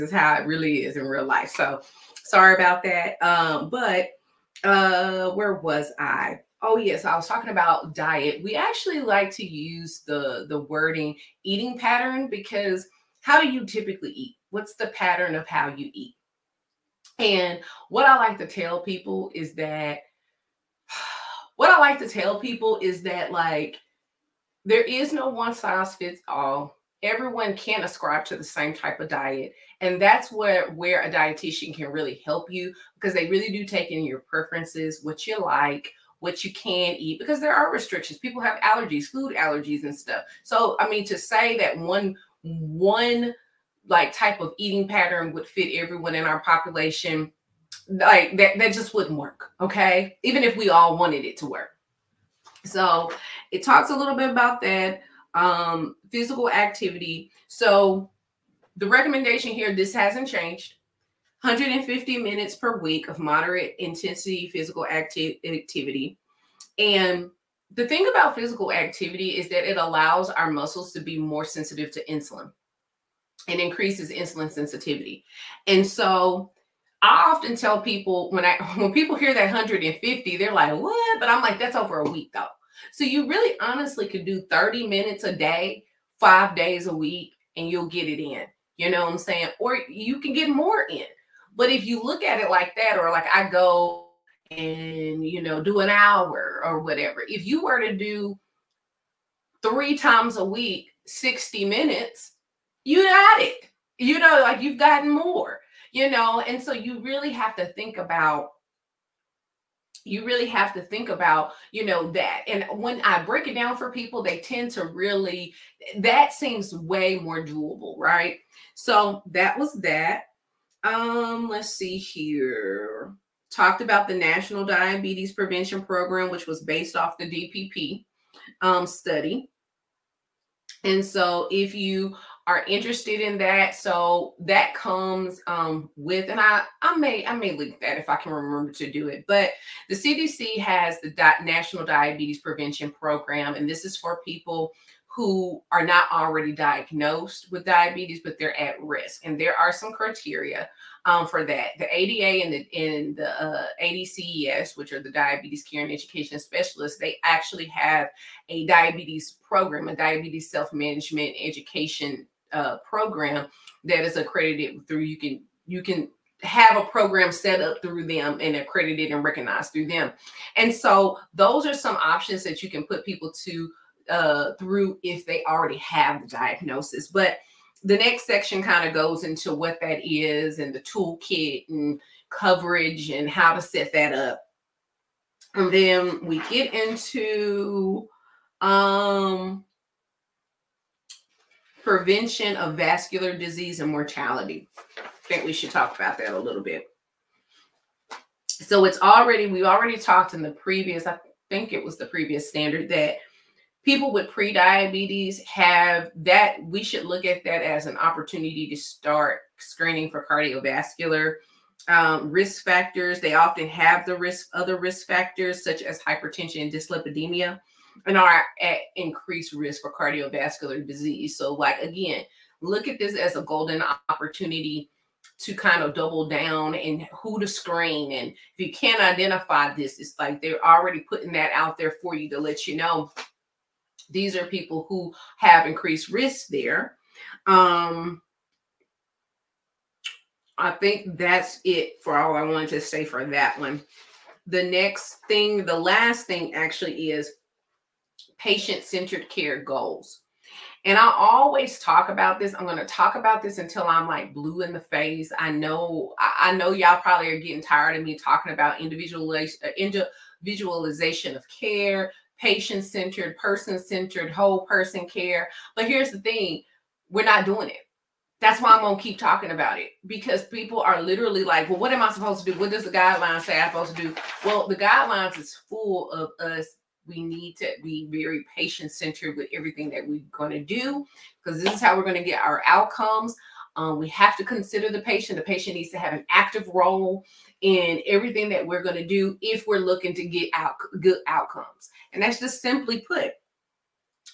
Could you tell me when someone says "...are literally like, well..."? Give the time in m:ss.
4:30.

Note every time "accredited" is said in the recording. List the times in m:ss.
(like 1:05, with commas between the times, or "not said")
2:44, 2:48.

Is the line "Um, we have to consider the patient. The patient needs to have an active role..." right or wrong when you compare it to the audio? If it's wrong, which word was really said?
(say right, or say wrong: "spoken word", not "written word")
right.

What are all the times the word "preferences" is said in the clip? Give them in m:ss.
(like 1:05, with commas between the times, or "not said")
0:34.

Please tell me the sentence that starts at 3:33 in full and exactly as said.
They often have the risk other risk factors such as hypertension and dyslipidemia and are at increased risk for cardiovascular disease.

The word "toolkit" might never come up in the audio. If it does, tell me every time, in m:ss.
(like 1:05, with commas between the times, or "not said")
3:00.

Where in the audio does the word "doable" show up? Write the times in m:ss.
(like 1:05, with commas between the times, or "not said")
1:57.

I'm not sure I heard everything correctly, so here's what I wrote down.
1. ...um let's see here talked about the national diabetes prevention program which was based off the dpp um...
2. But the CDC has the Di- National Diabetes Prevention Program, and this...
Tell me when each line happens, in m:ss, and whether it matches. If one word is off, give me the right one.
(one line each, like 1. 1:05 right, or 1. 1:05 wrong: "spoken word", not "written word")
1. 2:00 right
2. 2:19 right.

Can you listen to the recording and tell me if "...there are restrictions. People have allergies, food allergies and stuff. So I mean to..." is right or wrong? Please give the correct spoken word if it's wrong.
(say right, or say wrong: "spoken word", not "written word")
right.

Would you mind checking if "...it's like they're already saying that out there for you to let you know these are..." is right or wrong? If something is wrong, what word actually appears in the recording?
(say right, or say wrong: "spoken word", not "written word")
wrong: "putting", not "saying".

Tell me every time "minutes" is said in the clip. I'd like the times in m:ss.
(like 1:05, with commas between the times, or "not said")
1:02, 1:24, 1:41.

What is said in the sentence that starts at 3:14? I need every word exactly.
I think we should talk about that a little bit.